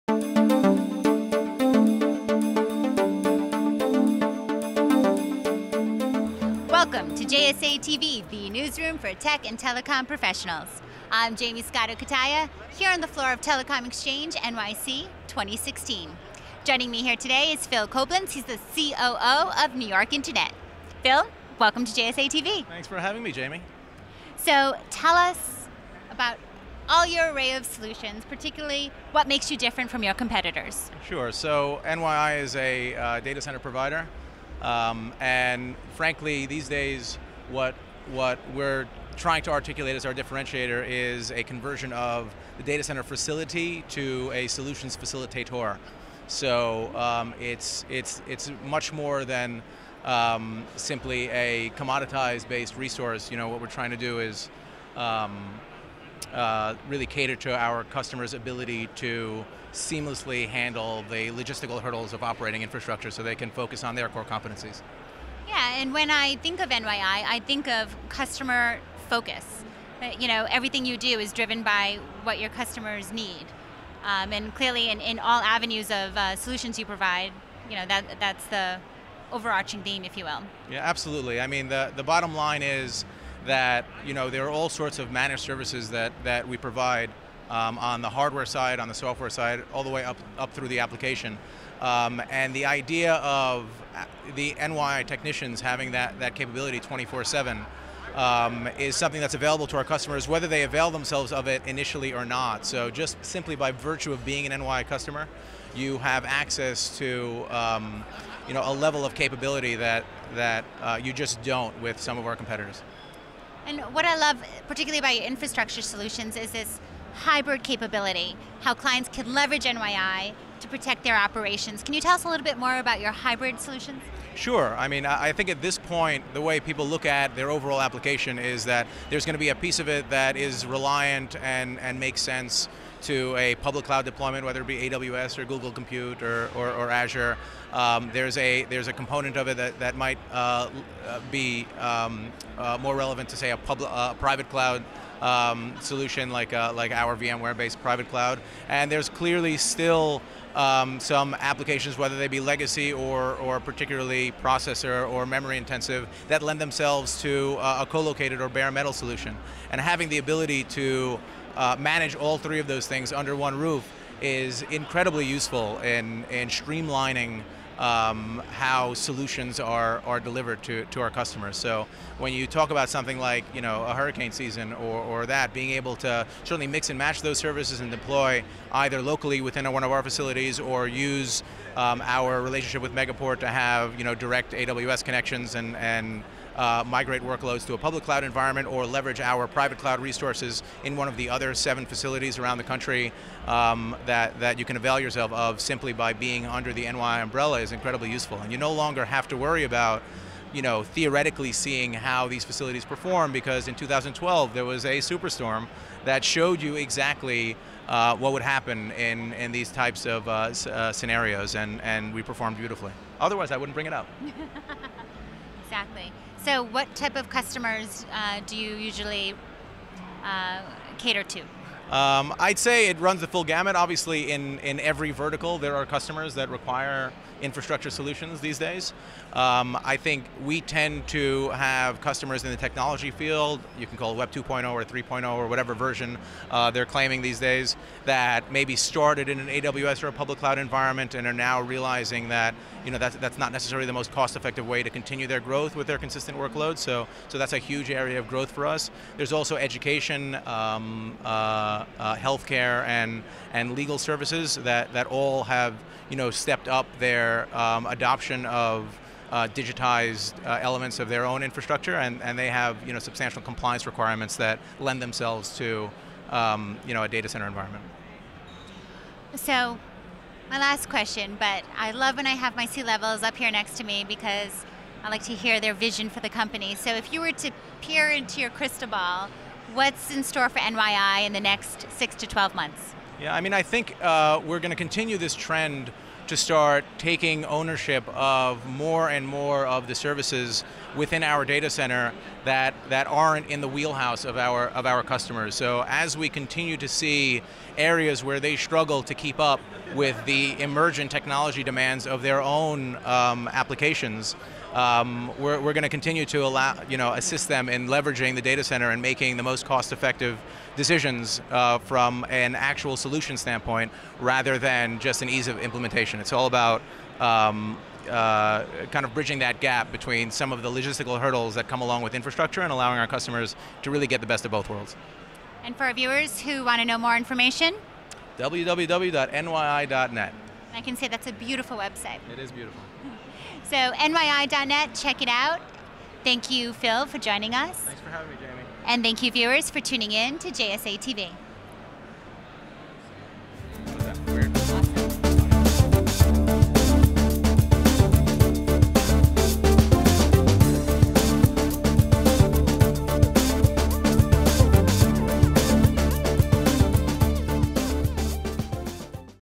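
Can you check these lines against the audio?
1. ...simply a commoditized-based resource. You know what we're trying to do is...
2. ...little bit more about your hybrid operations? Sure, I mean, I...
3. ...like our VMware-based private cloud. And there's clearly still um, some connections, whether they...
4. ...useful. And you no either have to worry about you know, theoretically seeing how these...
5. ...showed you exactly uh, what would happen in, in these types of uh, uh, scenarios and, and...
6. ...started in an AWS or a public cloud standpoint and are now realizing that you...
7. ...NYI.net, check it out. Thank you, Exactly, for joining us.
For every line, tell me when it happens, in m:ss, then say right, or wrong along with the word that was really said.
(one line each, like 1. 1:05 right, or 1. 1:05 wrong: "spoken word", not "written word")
1. 0:50 right
2. 2:02 wrong: "solutions", not "operations"
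3. 2:26 wrong: "applications", not "connections"
4. 3:18 wrong: "longer", not "either"
5. 3:26 right
6. 3:58 wrong: "environment", not "standpoint"
7. 5:33 wrong: "Phil", not "Exactly".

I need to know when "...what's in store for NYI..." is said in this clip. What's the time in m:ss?
4:39.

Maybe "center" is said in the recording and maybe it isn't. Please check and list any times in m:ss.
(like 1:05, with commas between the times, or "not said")
0:33, 0:42, 4:27, 4:51, 5:08.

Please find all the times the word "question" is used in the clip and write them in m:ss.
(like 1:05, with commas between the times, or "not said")
4:30.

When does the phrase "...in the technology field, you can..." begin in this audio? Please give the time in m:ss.
3:52.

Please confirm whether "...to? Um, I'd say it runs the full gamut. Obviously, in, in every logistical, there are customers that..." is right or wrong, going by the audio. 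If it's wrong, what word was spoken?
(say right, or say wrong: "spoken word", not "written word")
wrong: "vertical", not "logistical".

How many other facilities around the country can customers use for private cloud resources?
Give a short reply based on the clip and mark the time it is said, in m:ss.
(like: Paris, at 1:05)
7, at 3:11.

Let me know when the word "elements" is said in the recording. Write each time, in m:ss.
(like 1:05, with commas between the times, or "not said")
4:20.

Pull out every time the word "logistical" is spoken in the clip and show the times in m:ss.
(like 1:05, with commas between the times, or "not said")
1:01, 5:20.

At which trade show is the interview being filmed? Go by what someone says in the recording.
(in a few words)
Telecom Exchange NYC 2016.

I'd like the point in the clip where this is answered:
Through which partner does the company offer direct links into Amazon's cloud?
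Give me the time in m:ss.
3:02.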